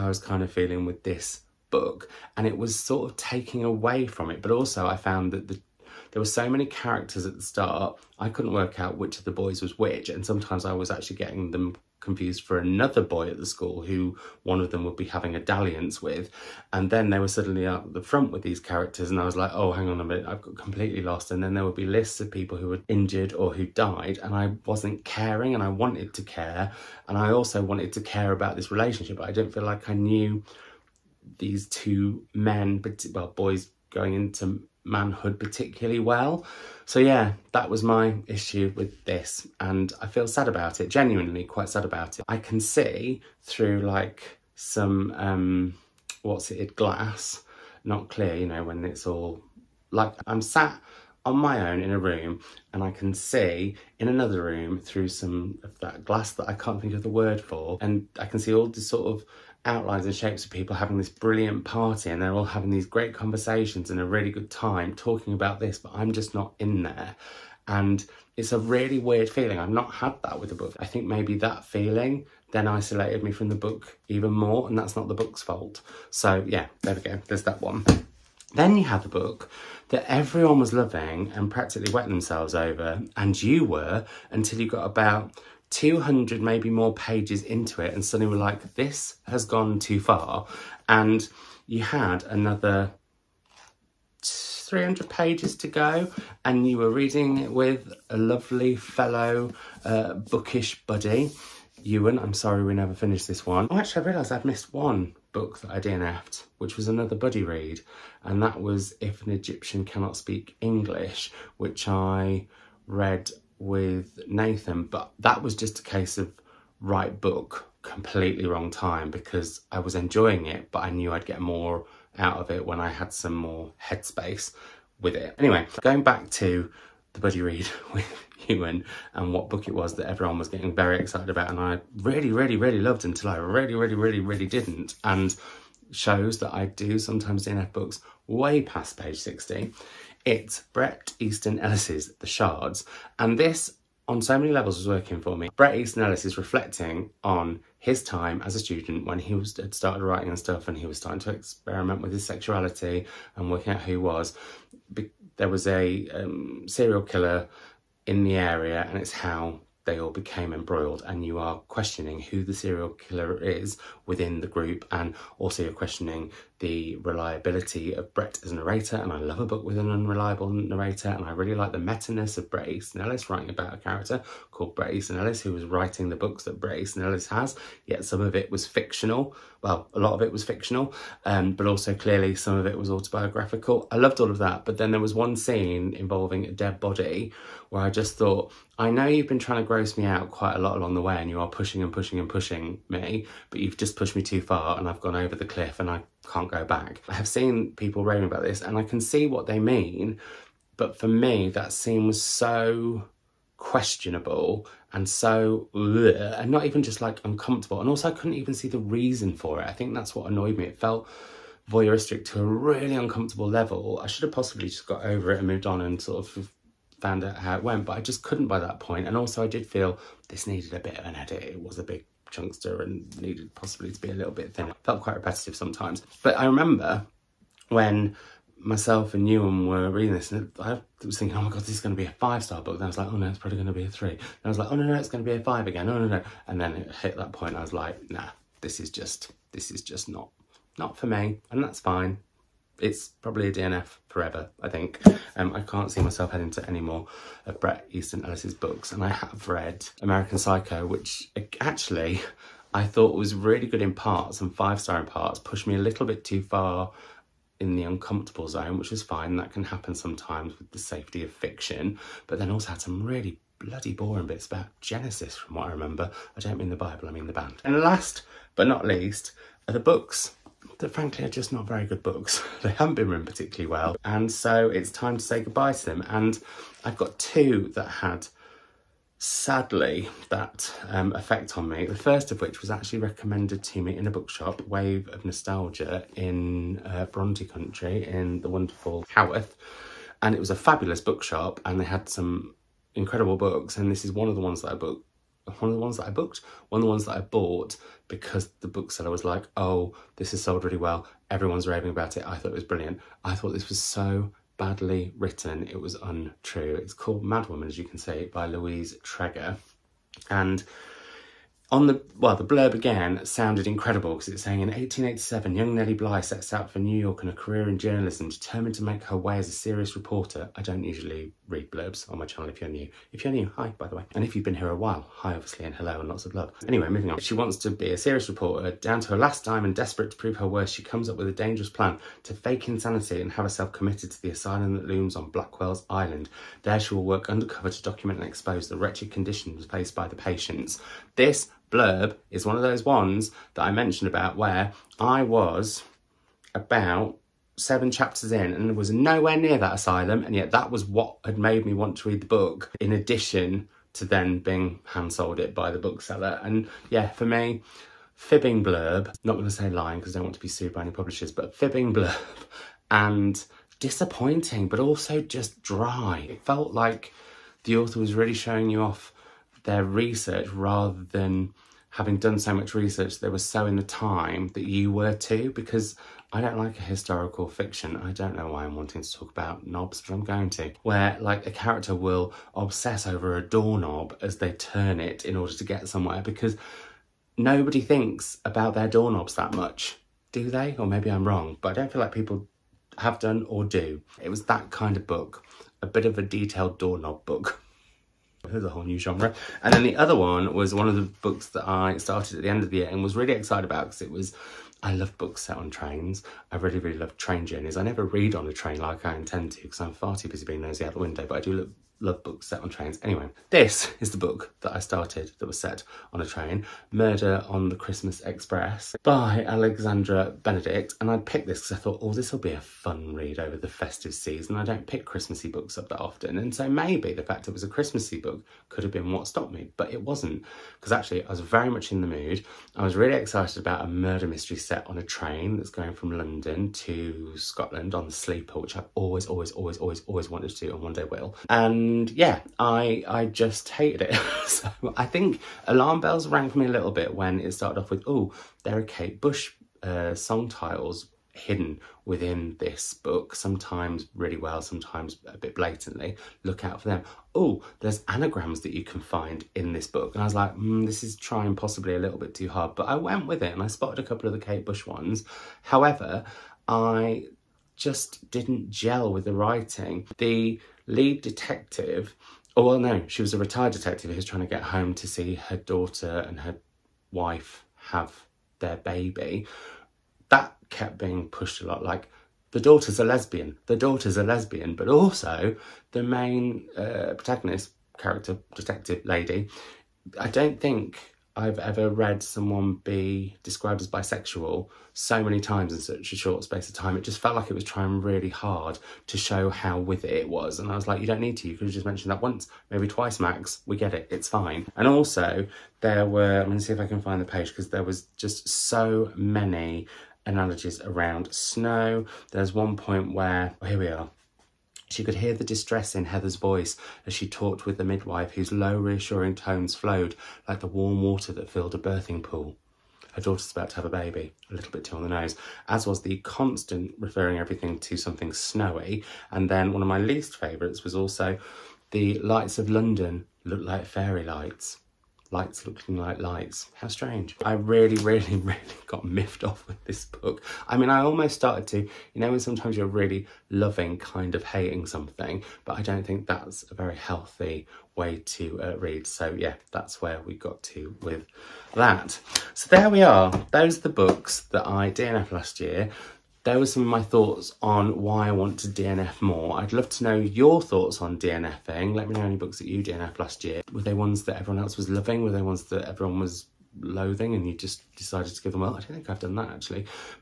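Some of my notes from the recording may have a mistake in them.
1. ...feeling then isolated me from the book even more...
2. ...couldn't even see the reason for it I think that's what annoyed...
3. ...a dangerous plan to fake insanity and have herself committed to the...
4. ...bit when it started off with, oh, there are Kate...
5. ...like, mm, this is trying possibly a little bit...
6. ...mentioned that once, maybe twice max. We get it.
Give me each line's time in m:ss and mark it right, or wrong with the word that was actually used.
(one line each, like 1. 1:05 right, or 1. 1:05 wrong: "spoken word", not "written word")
1. 1:11 right
2. 3:28 right
3. 5:31 right
4. 7:26 right
5. 7:40 right
6. 8:21 right.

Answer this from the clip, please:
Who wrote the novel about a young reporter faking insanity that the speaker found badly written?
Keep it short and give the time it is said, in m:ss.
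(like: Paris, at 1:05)
Louise Treger, at 5:08.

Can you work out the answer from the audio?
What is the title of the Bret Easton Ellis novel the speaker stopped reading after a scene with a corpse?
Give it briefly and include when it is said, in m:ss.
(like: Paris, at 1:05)
The Shards, at 2:22.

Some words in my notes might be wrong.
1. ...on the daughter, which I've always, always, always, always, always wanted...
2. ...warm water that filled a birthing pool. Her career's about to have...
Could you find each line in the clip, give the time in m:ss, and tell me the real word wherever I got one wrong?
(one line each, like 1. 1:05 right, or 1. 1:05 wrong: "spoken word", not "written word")
1. 7:17 wrong: "sleeper", not "daughter"
2. 8:40 wrong: "daughter", not "career".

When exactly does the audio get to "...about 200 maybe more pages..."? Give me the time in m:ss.
1:24.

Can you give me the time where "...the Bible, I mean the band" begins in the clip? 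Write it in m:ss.
4:26.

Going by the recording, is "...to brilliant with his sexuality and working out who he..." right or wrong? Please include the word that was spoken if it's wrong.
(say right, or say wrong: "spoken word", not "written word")
wrong: "experiment", not "brilliant".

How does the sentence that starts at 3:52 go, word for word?
Then I was like, oh no, it's probably going to be a three.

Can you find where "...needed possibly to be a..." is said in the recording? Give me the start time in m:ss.
3:43.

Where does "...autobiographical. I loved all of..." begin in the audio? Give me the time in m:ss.
3:02.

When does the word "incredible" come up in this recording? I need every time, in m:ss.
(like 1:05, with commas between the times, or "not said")
4:52, 5:13.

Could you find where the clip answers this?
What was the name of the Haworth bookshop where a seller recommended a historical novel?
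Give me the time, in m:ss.
4:44.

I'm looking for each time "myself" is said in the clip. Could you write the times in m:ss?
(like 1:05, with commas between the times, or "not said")
3:48, 4:06.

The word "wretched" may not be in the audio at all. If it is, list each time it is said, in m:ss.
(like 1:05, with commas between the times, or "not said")
5:38.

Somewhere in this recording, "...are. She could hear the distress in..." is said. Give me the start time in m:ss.
8:33.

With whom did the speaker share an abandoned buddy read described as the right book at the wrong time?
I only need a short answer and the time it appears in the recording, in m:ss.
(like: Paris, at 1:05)
Nathan, at 1:54.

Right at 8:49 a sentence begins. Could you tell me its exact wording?
And then one of my least favourites was also the lights of London looked like fairy lights lights looking like lights.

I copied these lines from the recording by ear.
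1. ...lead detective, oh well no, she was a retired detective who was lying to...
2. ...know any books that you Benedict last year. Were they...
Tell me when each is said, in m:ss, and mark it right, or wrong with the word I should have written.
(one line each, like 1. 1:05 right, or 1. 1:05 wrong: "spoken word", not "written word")
1. 7:50 wrong: "trying", not "lying"
2. 9:22 wrong: "DNF", not "Benedict".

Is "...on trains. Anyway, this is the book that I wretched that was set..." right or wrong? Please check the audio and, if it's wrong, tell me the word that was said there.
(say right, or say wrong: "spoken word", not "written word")
wrong: "started", not "wretched".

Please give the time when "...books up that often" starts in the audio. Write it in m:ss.
7:05.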